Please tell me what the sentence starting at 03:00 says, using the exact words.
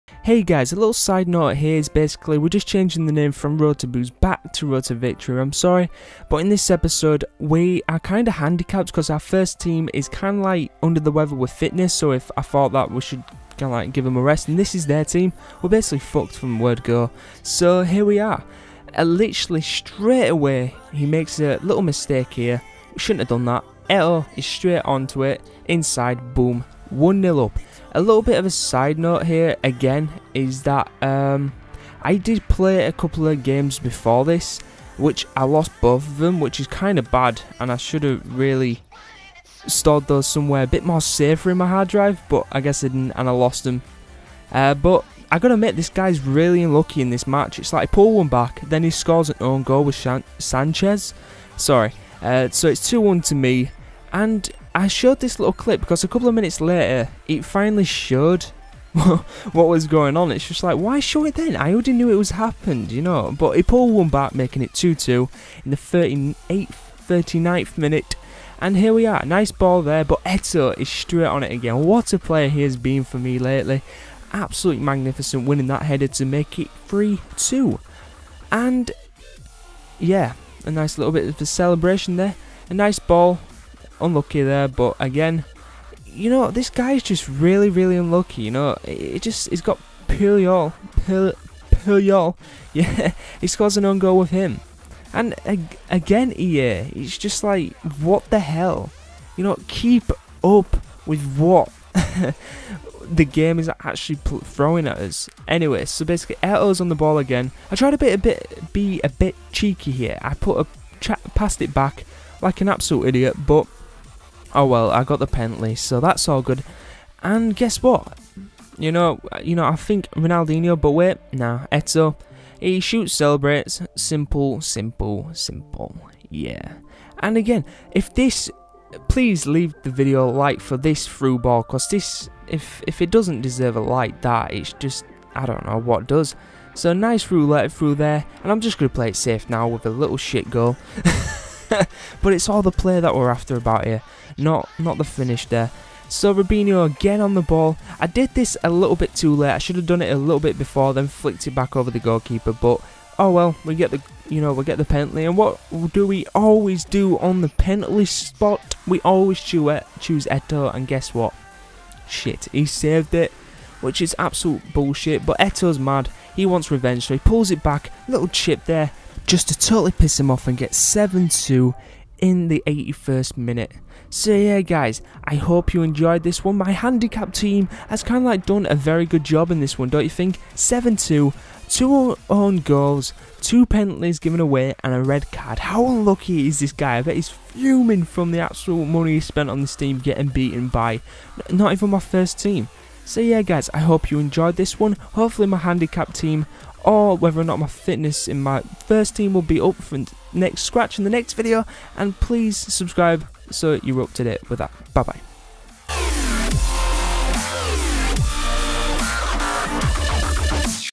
7-2, two own goals, two penalties given away and a red card.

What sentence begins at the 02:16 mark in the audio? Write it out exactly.
So nice roulette through there, and I'm just gonna play it safe now with a little shit goal.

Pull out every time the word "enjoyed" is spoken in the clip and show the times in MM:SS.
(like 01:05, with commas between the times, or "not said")
02:55, 03:14.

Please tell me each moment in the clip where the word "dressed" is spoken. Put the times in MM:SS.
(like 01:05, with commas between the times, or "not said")
not said.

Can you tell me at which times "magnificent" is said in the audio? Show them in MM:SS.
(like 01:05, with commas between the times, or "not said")
01:14.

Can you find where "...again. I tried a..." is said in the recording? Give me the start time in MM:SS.
01:47.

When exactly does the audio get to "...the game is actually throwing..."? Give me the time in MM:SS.
01:43.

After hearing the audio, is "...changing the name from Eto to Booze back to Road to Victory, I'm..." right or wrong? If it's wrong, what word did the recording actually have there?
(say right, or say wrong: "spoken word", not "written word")
wrong: "Road", not "Eto".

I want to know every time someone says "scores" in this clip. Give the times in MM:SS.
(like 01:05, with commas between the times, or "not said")
00:48, 01:33.